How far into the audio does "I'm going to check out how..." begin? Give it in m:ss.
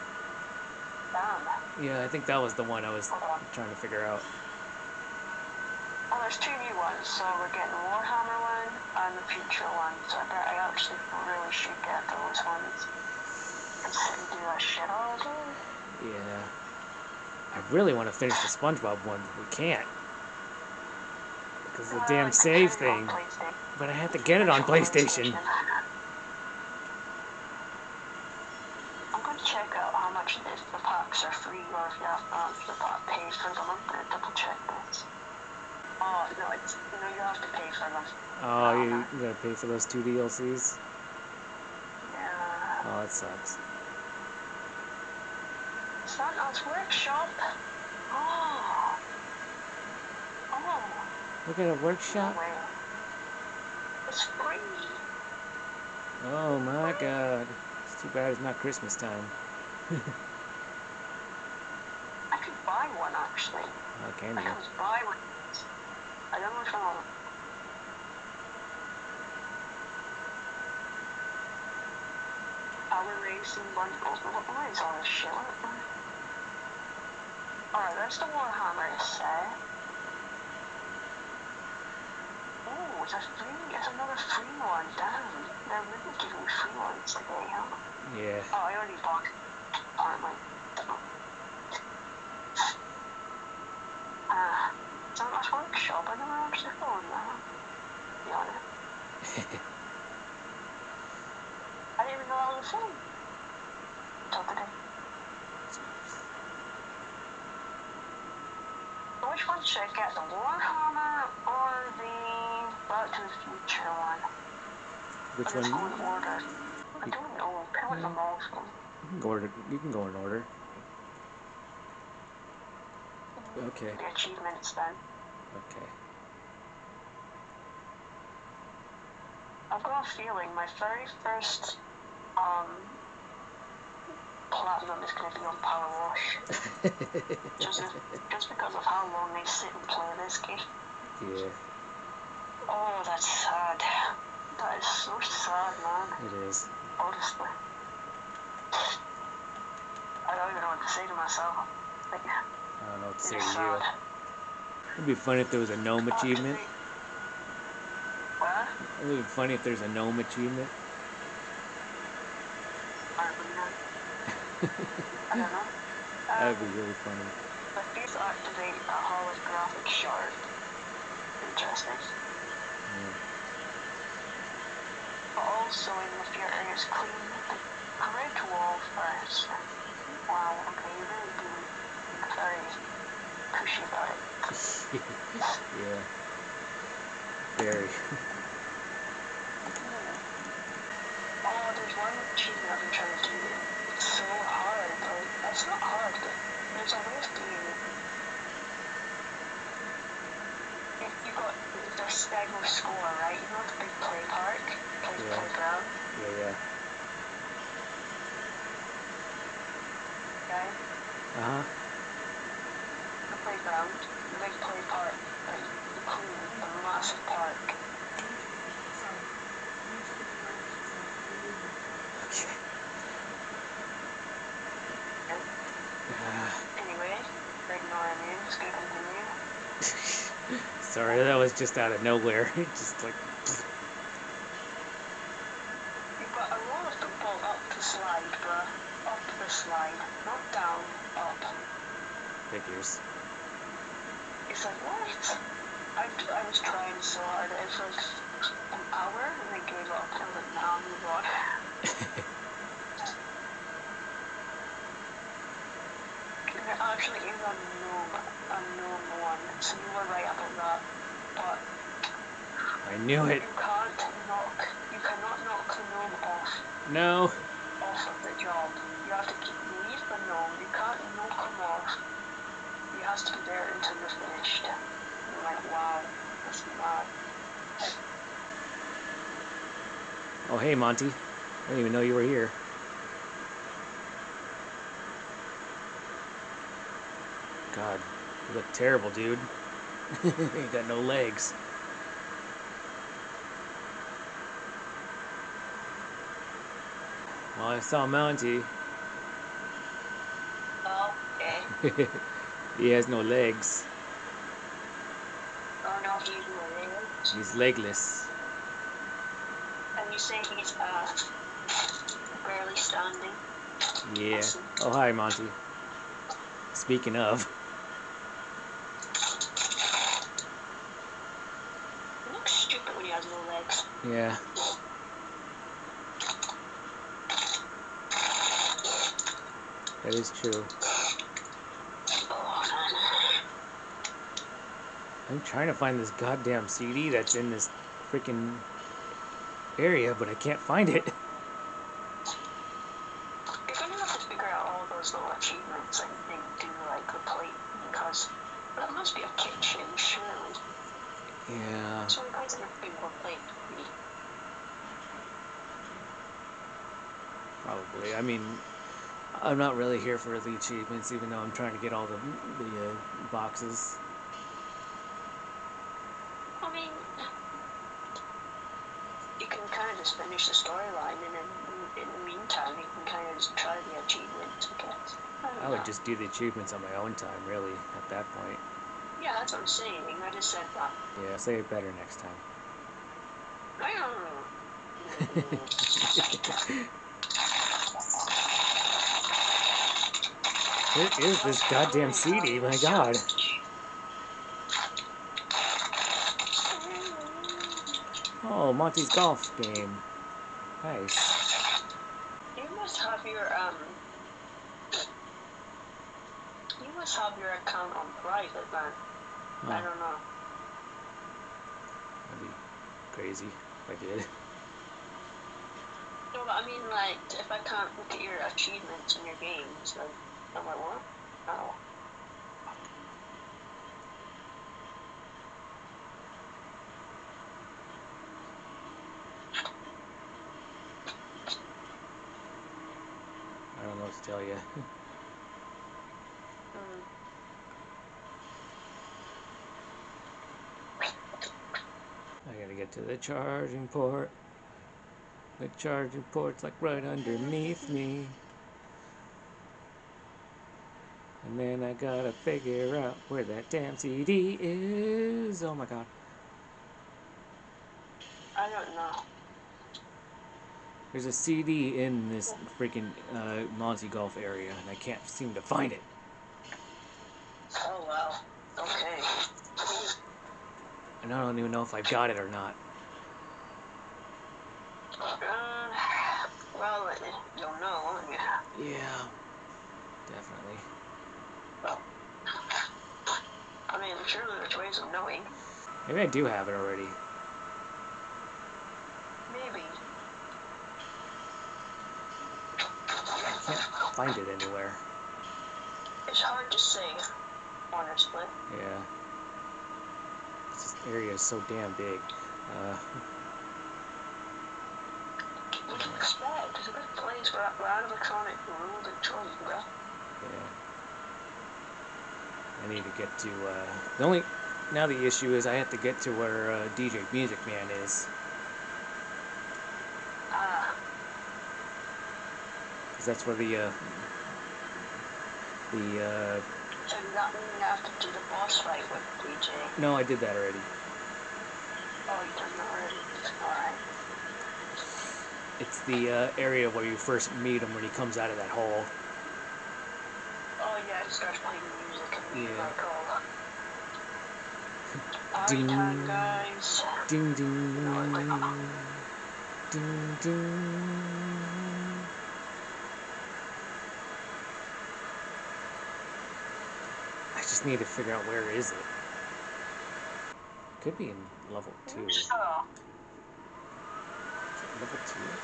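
0:29.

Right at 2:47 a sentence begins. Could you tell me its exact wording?
Uh, but these activate a uh, holographic shard.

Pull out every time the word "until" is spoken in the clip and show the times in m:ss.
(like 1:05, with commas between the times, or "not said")
1:44, 4:33.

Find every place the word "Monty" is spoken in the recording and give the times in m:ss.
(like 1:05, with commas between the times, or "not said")
4:40, 4:58, 5:15, 6:38, 7:43.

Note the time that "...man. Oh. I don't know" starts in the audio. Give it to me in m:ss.
6:48.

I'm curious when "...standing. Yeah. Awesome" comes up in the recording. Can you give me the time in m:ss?
5:12.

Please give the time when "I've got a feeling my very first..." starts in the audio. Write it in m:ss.
2:09.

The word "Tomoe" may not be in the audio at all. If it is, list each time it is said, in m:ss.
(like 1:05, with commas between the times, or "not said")
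not said.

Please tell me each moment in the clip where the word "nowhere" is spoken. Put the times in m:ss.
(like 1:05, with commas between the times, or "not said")
3:52.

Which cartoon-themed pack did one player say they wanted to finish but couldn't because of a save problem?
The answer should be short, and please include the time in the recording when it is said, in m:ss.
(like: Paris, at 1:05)
SpongeBob, at 0:18.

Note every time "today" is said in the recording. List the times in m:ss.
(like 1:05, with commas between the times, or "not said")
1:27, 1:44.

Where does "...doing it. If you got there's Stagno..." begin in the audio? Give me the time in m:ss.
3:17.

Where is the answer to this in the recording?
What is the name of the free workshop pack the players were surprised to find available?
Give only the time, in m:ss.
0:46.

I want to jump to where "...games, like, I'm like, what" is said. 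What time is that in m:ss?
6:59.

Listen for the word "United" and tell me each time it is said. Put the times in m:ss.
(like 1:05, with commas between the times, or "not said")
not said.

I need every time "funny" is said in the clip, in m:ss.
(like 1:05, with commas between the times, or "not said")
2:35, 2:39, 2:47.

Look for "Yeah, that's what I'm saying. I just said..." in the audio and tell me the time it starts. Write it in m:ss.
6:19.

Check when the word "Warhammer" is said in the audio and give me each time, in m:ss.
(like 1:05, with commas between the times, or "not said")
0:07, 1:18, 1:50.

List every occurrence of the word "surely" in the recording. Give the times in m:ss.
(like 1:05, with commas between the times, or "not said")
5:49, 8:04.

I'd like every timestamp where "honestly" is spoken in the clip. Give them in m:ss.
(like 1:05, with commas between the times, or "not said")
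2:26, 8:17.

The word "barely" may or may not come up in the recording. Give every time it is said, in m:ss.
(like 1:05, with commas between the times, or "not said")
5:12.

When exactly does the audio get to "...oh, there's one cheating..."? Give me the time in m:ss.
3:11.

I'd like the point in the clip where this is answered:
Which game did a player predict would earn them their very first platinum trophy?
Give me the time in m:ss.
2:15.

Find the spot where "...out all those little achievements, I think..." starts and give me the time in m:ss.
5:44.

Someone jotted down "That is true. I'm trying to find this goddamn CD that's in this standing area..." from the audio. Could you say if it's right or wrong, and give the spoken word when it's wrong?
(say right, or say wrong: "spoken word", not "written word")
wrong: "freaking", not "standing".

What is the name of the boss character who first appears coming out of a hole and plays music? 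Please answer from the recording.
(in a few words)
DJ Music Man.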